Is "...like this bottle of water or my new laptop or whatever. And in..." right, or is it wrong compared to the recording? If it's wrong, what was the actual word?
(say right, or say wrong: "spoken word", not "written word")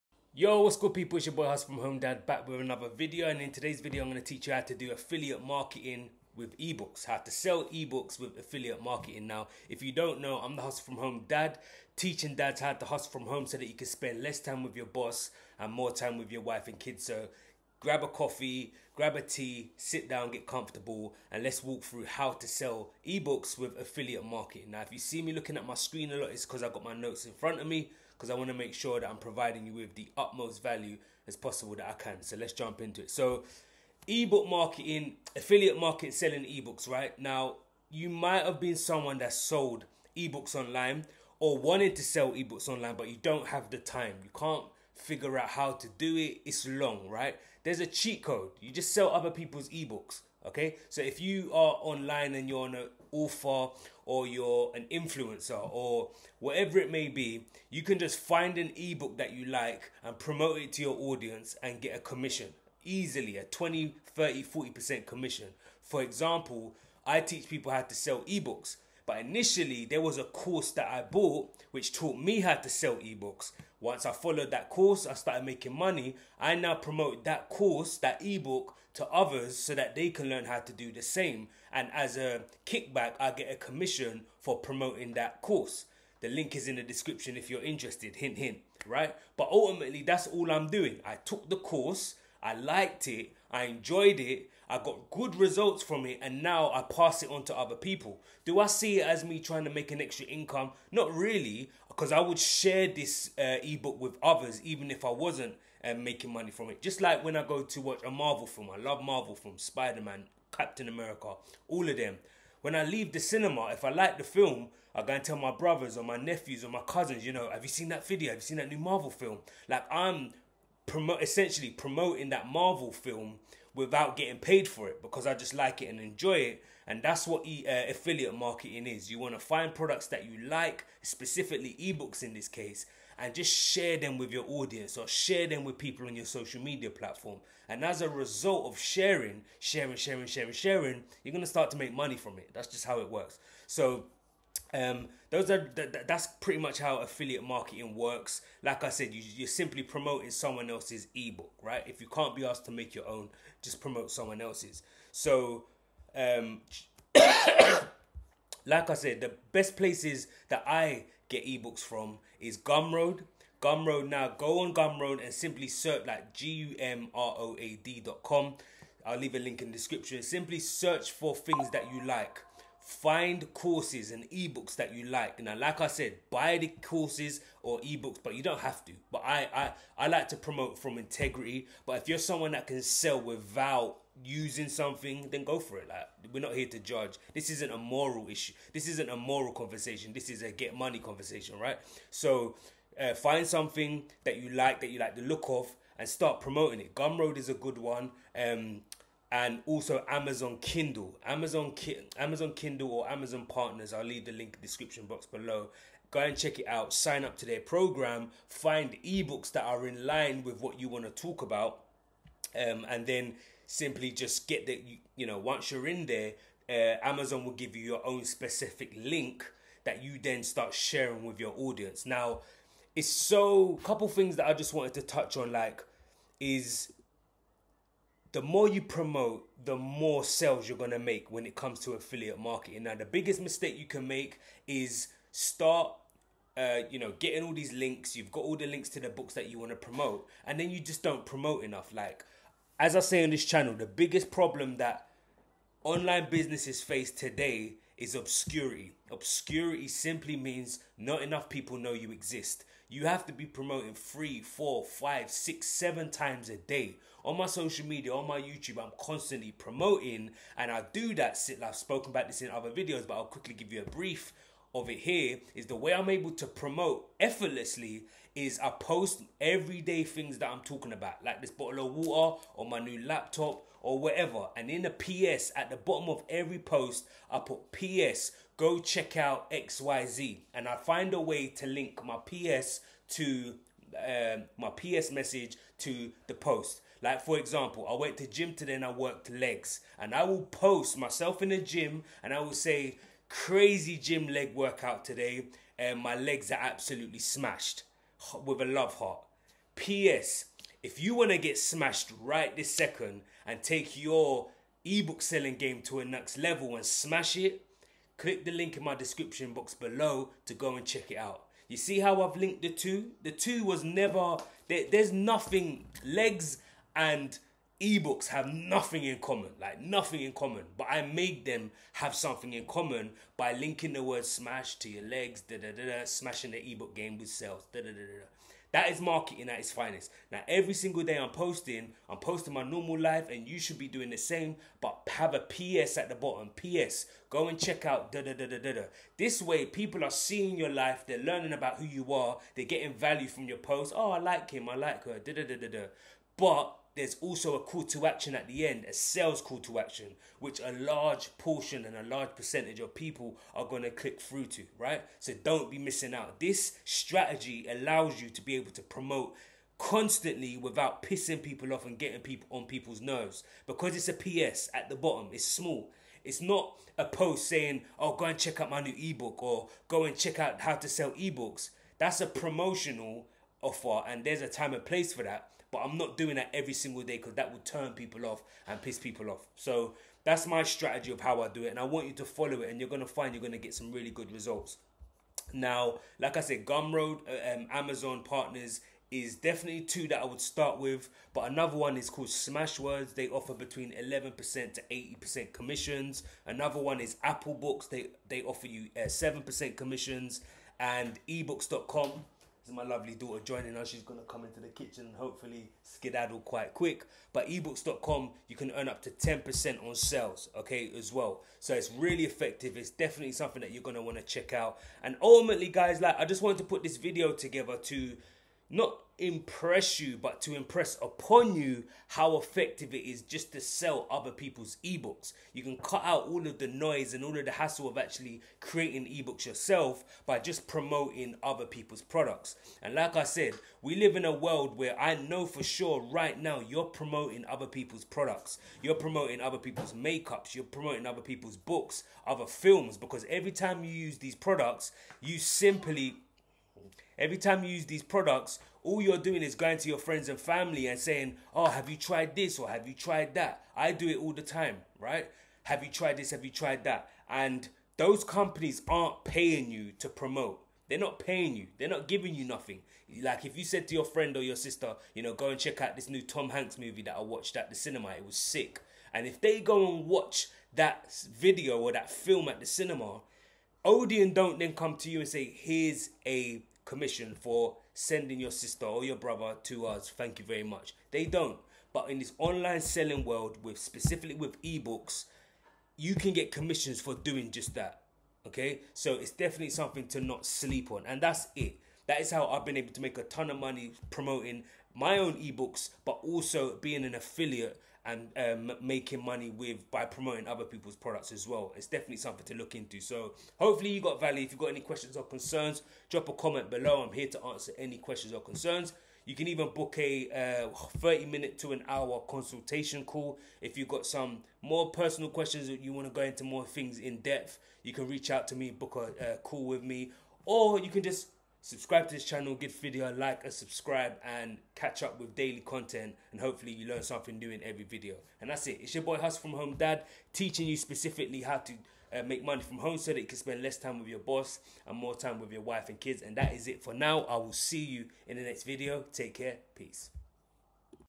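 right.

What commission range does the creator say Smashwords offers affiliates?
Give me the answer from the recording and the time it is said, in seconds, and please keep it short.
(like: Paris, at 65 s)
11% to 80%, at 393 s.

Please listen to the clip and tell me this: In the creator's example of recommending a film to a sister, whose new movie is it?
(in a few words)
Tom Hanks.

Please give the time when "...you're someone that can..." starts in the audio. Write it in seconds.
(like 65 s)
182 s.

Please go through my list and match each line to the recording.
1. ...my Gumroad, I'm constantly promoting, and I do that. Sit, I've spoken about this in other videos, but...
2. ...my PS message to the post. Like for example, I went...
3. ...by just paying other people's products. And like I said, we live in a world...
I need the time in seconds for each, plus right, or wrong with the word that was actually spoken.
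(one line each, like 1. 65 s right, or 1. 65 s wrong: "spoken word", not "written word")
1. 258 s wrong: "YouTube", not "Gumroad"
2. 284 s right
3. 430 s wrong: "promoting", not "paying".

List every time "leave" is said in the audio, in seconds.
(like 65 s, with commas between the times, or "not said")
112 s, 169 s, 204 s.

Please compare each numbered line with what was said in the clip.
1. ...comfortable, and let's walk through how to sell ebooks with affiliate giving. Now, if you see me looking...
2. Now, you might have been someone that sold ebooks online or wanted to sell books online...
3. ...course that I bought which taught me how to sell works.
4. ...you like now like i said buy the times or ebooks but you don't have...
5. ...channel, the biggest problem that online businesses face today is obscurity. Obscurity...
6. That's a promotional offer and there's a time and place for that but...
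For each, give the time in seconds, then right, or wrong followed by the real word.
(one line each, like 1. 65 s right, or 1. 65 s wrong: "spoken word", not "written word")
1. 20 s wrong: "marketing", not "giving"
2. 37 s wrong: "ebooks", not "books"
3. 70 s wrong: "ebooks", not "works"
4. 174 s wrong: "courses", not "times"
5. 243 s right
6. 371 s right.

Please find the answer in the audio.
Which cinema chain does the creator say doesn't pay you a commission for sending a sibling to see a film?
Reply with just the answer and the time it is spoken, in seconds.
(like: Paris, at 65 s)
Odeon, at 473 s.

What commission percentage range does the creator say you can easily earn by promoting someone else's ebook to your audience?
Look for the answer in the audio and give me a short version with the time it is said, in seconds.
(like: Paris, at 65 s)
20, 30, 40%, at 63 s.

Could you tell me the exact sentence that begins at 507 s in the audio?
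I'm here to answer any questions or concerns.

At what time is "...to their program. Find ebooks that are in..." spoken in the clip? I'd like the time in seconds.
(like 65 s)
207 s.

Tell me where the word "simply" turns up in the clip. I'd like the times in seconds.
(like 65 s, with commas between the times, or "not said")
149 s, 165 s, 170 s, 213 s, 249 s, 445 s.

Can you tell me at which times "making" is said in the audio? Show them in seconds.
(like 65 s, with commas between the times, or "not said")
75 s, 105 s, 498 s.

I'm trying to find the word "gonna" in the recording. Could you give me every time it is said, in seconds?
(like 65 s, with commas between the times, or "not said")
230 s, 404 s, 413 s.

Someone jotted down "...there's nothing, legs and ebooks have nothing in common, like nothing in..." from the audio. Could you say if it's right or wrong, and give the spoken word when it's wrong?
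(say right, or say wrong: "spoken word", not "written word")
right.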